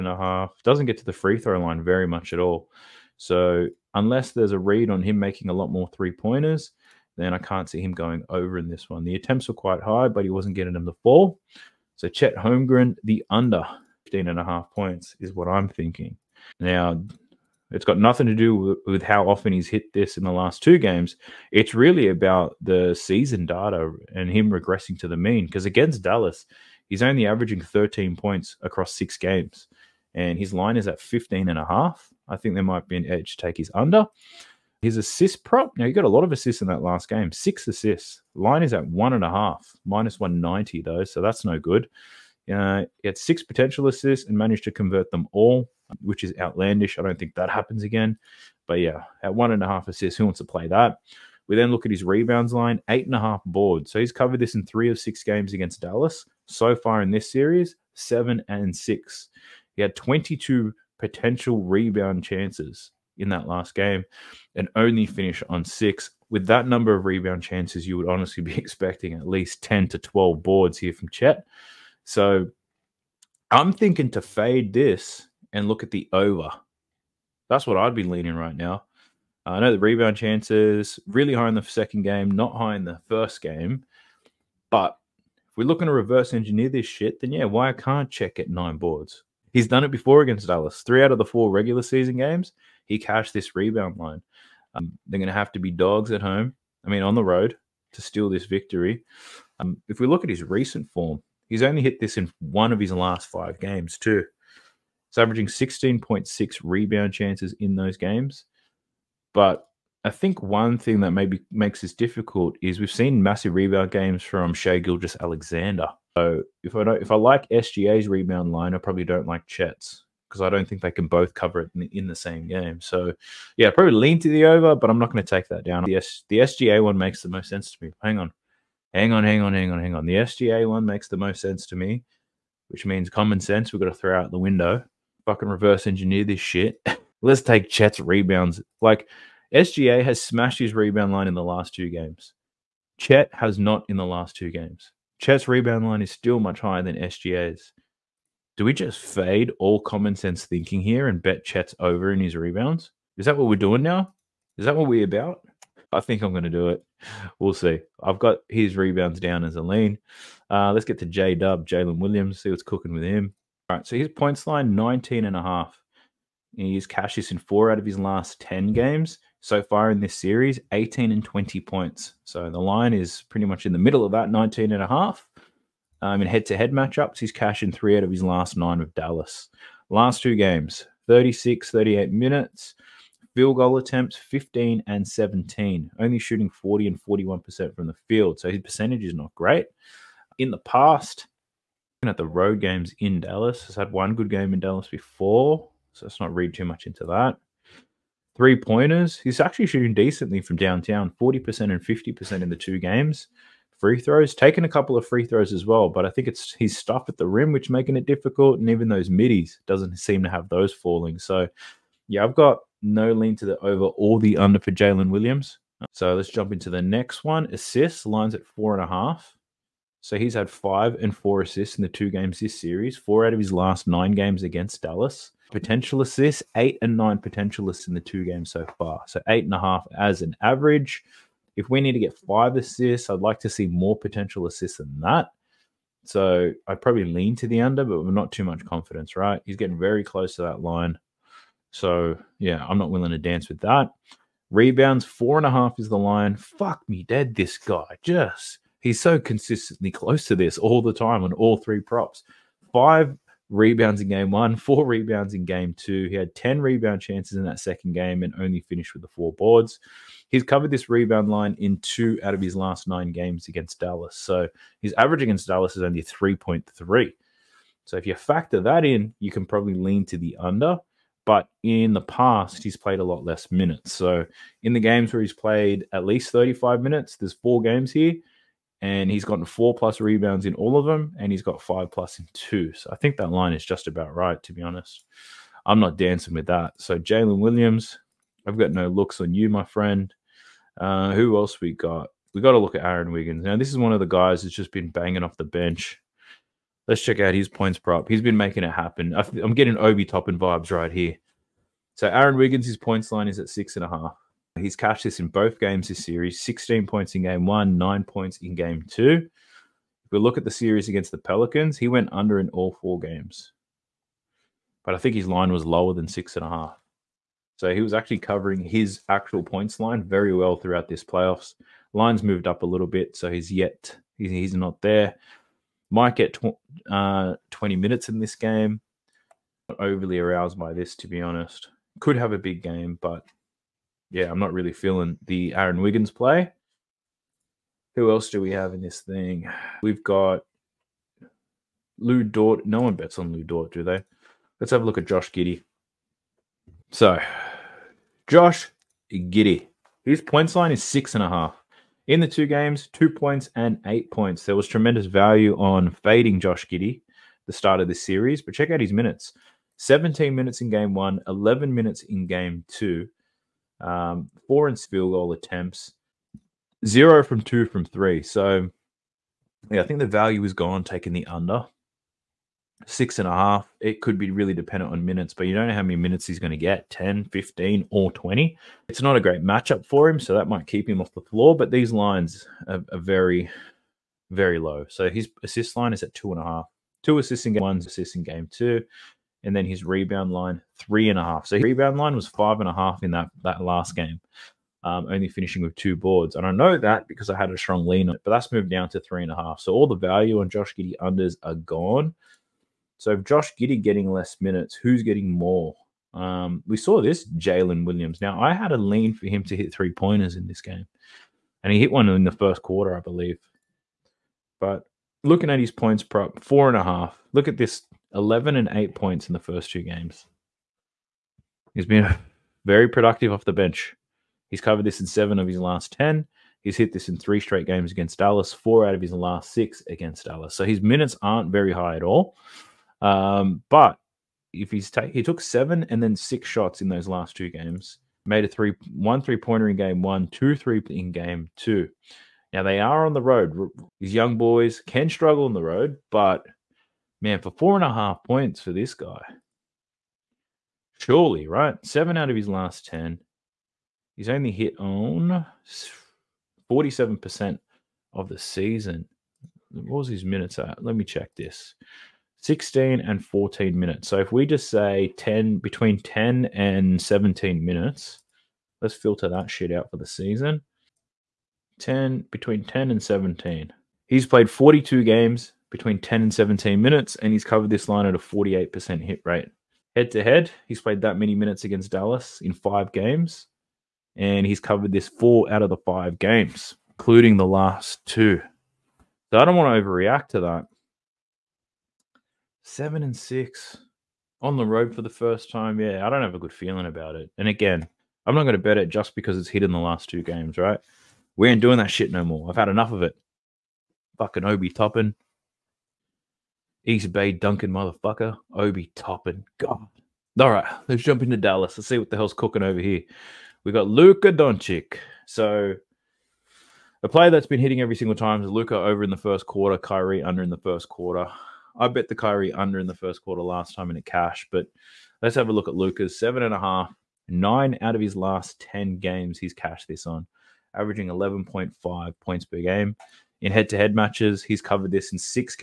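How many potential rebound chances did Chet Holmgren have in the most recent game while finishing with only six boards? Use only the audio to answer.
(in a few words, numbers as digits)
22.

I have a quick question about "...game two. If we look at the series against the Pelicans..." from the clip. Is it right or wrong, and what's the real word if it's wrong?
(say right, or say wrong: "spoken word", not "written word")
right.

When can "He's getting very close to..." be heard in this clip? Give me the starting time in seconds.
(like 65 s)
239 s.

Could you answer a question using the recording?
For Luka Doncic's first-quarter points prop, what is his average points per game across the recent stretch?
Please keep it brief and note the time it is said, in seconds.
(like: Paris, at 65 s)
11.5, at 531 s.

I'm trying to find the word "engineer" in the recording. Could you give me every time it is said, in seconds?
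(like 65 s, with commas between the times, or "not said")
86 s, 135 s.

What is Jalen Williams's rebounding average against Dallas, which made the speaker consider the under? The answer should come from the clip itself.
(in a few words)
3.3.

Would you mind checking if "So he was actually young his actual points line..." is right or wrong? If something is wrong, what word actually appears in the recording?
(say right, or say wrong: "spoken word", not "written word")
wrong: "covering", not "young".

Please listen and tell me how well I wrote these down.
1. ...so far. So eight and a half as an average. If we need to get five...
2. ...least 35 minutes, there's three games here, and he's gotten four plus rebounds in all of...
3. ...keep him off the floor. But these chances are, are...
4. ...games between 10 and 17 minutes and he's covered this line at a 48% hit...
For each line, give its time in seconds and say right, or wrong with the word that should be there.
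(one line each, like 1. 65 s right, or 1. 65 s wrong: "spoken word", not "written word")
1. 228 s right
2. 276 s wrong: "four", not "three"
3. 380 s wrong: "lines", not "chances"
4. 475 s right.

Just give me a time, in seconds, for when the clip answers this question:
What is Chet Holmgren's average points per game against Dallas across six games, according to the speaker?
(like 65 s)
27 s.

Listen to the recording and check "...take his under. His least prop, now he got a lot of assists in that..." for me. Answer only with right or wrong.
wrong.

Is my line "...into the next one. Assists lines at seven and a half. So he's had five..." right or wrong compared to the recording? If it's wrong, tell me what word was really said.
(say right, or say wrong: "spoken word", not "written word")
wrong: "four", not "seven".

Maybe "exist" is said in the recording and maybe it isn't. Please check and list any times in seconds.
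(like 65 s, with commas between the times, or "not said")
not said.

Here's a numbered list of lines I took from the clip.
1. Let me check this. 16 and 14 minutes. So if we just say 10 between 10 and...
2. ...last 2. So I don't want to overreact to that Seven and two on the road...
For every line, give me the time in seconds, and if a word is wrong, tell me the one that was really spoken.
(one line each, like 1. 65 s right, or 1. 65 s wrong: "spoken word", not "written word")
1. 460 s right
2. 487 s wrong: "six", not "two".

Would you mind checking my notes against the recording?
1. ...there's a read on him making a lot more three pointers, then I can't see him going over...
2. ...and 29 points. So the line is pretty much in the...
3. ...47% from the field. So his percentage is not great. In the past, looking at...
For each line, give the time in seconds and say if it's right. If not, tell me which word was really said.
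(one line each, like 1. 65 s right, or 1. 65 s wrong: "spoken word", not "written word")
1. 4 s right
2. 171 s wrong: "20", not "29"
3. 187 s wrong: "41", not "47".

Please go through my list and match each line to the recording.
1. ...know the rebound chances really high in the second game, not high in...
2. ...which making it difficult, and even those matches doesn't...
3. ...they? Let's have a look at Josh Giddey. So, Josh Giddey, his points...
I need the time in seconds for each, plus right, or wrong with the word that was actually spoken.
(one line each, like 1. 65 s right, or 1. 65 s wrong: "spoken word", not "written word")
1. 79 s right
2. 207 s wrong: "middies", not "matches"
3. 343 s right.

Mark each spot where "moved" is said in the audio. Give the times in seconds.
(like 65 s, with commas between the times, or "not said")
322 s, 398 s.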